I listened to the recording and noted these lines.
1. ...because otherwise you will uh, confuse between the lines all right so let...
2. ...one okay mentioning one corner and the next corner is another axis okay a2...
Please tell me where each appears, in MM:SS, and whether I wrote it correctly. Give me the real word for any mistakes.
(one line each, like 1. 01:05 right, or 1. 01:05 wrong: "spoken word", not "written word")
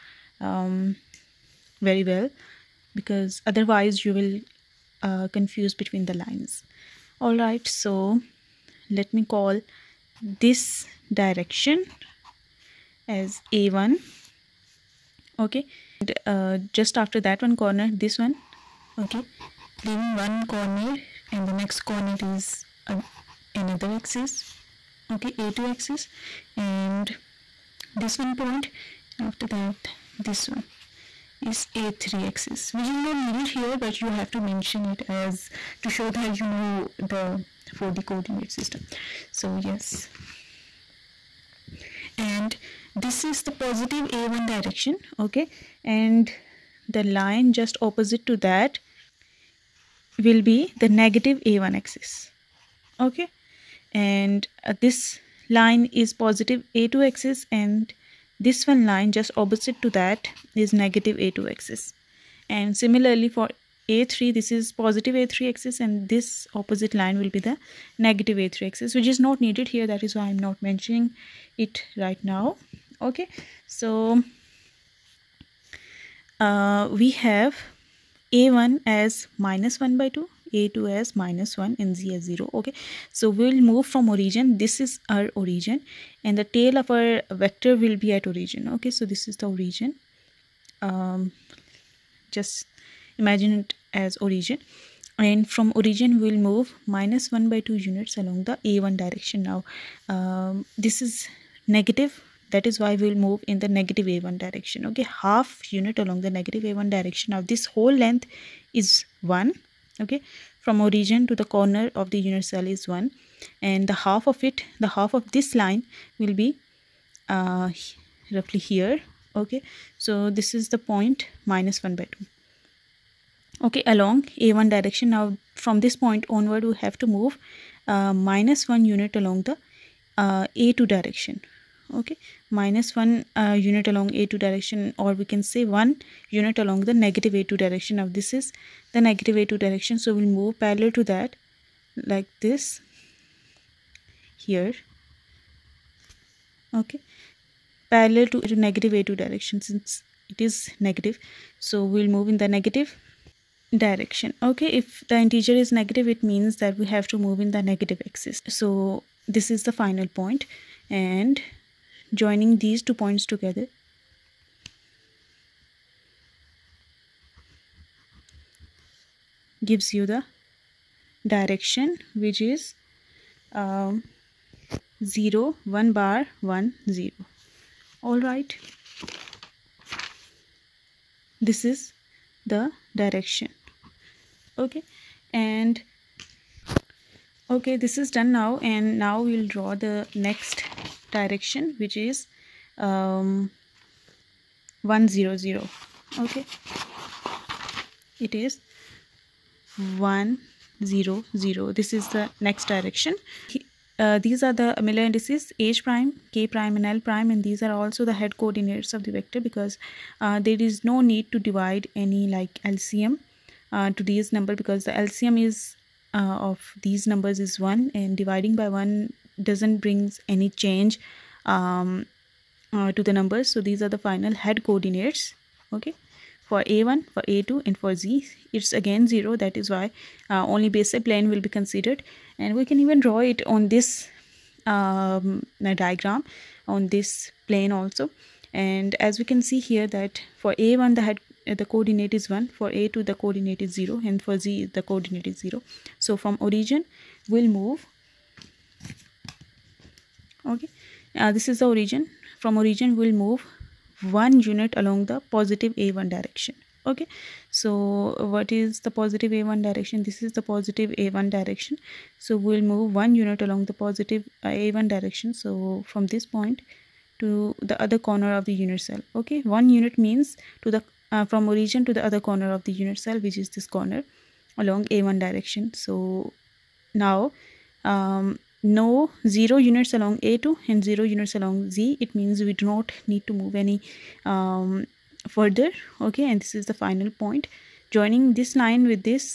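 1. 00:02 right
2. 00:18 wrong: "leaving", not "mentioning".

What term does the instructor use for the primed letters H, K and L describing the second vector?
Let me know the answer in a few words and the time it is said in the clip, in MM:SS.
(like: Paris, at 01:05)
Miller indices, at 03:24.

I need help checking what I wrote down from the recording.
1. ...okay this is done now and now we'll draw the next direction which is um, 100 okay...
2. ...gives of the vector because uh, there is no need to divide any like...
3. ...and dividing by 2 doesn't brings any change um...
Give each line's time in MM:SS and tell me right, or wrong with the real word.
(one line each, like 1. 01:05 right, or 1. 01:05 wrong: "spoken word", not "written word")
1. 03:07 right
2. 03:28 wrong: "coordinates", not "gives"
3. 03:37 wrong: "1", not "2".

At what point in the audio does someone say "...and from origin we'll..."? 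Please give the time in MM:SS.
01:35.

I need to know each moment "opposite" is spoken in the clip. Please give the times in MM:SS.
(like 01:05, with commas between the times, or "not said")
00:47, 00:59, 01:06.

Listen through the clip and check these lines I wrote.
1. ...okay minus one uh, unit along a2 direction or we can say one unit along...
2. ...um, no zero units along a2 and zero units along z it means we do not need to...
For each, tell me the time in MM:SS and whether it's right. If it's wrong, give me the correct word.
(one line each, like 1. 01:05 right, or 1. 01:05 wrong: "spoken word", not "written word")
1. 02:11 right
2. 04:37 right.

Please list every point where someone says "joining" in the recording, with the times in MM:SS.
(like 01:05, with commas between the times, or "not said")
02:42, 04:47.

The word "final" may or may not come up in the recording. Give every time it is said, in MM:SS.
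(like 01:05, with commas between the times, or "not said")
02:39, 03:43, 04:46.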